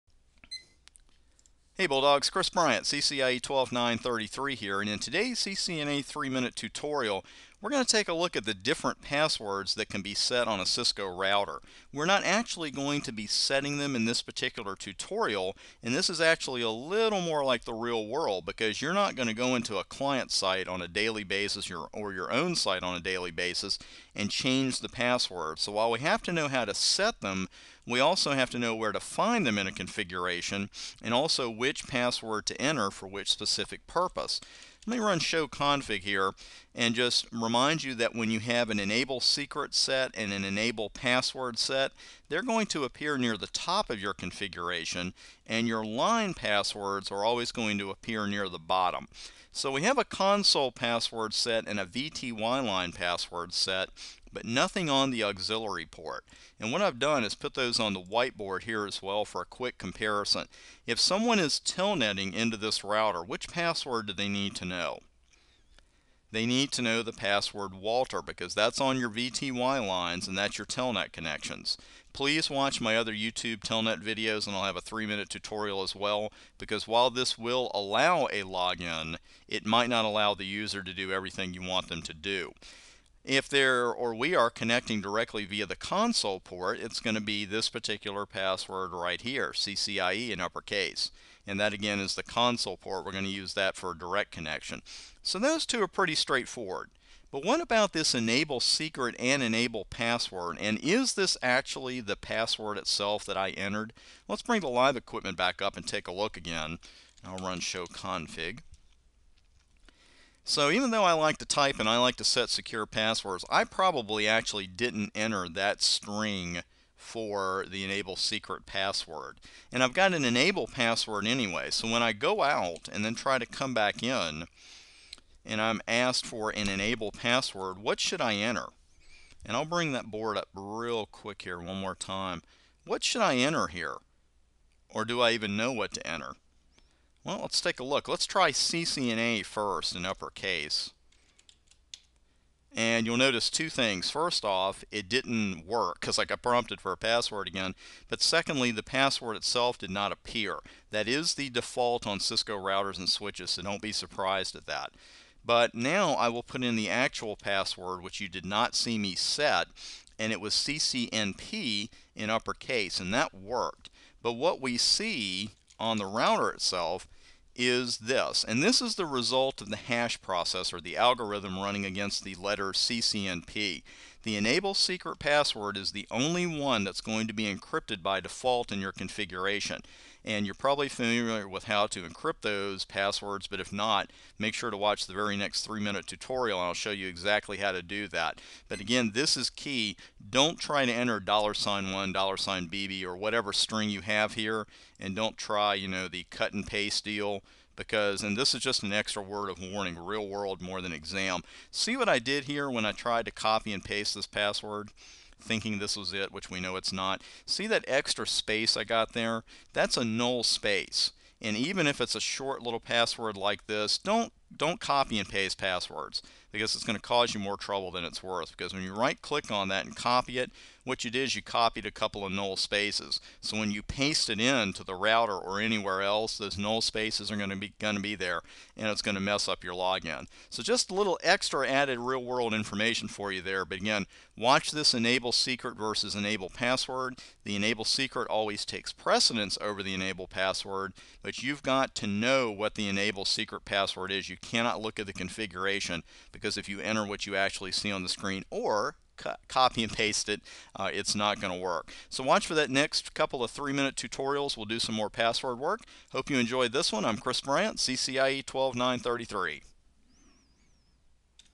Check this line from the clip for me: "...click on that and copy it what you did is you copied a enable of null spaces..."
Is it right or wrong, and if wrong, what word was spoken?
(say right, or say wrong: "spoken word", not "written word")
wrong: "couple", not "enable".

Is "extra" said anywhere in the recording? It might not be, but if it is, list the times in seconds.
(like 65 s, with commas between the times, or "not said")
198 s, 207 s, 231 s.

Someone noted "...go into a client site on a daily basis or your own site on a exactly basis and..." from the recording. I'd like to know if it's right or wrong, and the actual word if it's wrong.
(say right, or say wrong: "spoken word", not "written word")
wrong: "daily", not "exactly".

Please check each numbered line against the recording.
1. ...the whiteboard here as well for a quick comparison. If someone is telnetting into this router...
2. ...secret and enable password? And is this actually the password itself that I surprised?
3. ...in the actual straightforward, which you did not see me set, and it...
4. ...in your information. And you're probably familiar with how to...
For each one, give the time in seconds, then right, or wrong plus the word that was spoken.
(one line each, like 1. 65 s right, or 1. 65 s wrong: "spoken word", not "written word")
1. 57 s right
2. 98 s wrong: "entered", not "surprised"
3. 156 s wrong: "password", not "straightforward"
4. 178 s wrong: "configuration", not "information".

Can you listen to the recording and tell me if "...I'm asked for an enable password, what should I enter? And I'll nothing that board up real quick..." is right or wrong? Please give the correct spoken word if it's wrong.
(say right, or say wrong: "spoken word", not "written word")
wrong: "bring", not "nothing".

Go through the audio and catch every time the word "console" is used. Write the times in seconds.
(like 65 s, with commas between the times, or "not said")
50 s, 85 s, 92 s.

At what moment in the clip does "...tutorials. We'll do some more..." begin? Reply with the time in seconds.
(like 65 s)
253 s.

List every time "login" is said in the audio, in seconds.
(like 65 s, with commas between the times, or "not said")
78 s, 229 s.